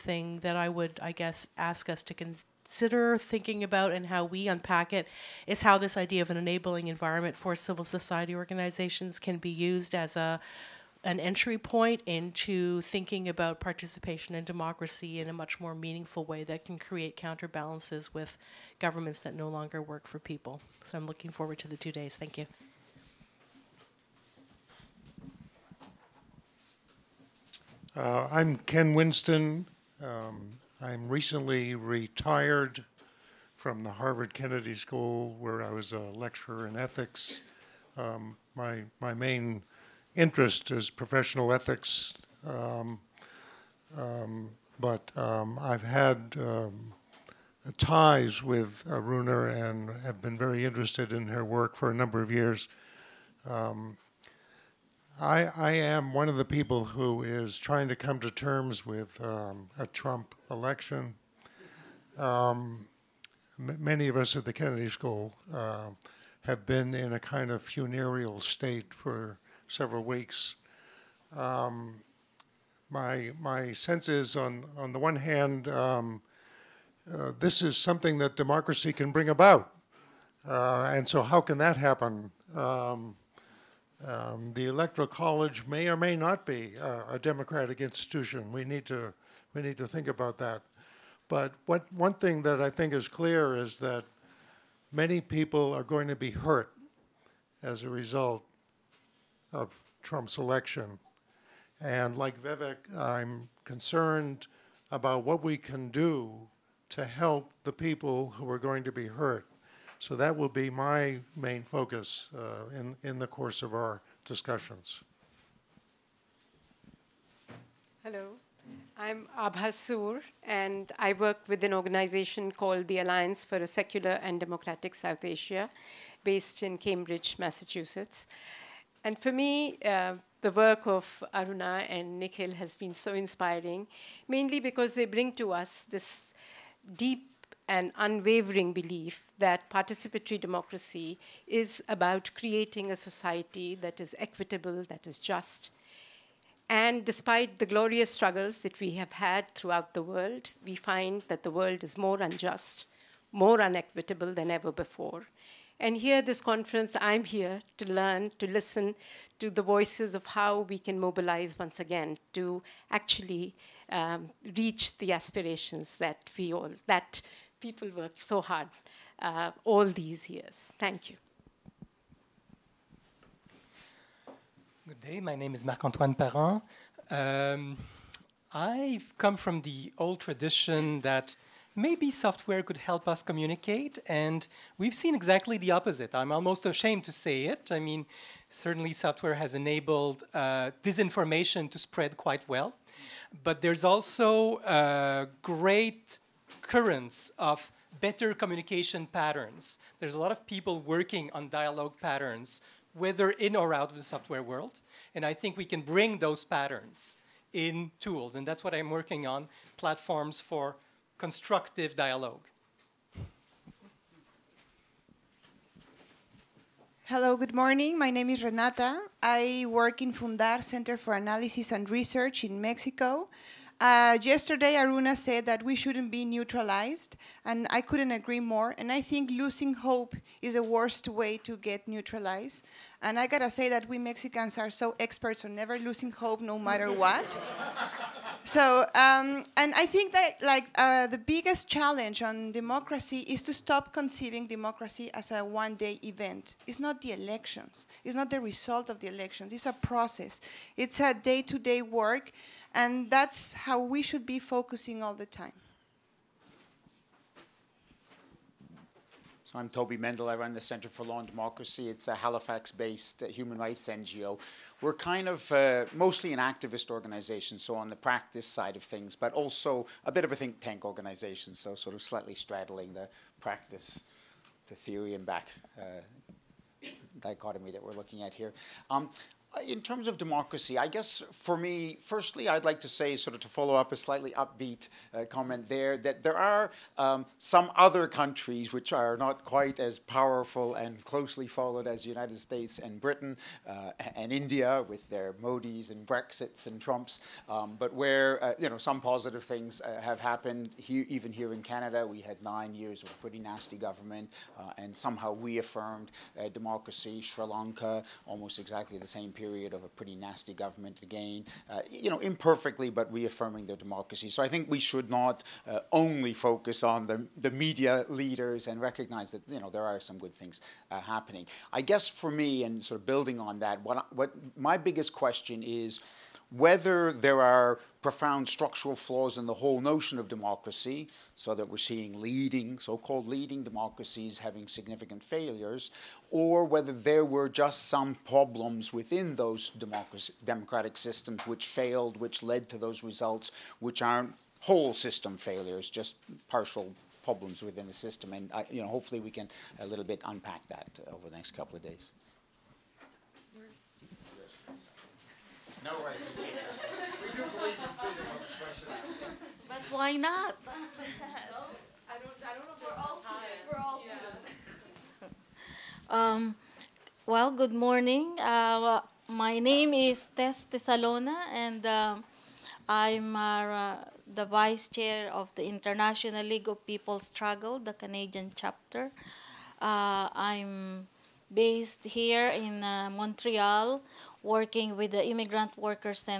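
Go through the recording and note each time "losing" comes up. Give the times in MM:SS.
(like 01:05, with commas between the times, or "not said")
03:49, 03:55.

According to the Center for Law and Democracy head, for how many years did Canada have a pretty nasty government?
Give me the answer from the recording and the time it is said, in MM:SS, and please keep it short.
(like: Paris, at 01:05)
9, at 05:02.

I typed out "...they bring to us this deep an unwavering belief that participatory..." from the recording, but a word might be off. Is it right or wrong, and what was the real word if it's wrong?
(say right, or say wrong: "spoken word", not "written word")
right.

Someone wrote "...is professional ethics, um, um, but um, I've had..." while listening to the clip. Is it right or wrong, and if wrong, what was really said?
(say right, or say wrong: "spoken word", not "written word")
right.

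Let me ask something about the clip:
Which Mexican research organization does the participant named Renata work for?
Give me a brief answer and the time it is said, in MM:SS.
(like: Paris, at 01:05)
Fundar Center for Analysis and Research, at 03:40.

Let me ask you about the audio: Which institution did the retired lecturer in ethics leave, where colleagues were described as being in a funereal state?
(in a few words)
Harvard Kennedy School.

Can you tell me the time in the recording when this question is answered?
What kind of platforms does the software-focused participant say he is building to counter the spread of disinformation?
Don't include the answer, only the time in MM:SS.
03:29.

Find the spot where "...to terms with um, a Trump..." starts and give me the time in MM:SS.
00:58.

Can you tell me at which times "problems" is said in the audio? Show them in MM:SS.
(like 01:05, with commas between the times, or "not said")
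05:38, 05:47.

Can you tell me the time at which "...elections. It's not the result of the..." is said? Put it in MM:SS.
04:07.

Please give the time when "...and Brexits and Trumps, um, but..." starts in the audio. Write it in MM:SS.
04:55.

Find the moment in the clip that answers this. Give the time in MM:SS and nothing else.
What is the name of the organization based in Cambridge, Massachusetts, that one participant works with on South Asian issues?
02:02.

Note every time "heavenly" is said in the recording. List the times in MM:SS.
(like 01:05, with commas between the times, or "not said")
not said.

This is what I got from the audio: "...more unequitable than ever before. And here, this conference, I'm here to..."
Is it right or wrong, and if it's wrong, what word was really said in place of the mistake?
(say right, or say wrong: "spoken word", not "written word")
right.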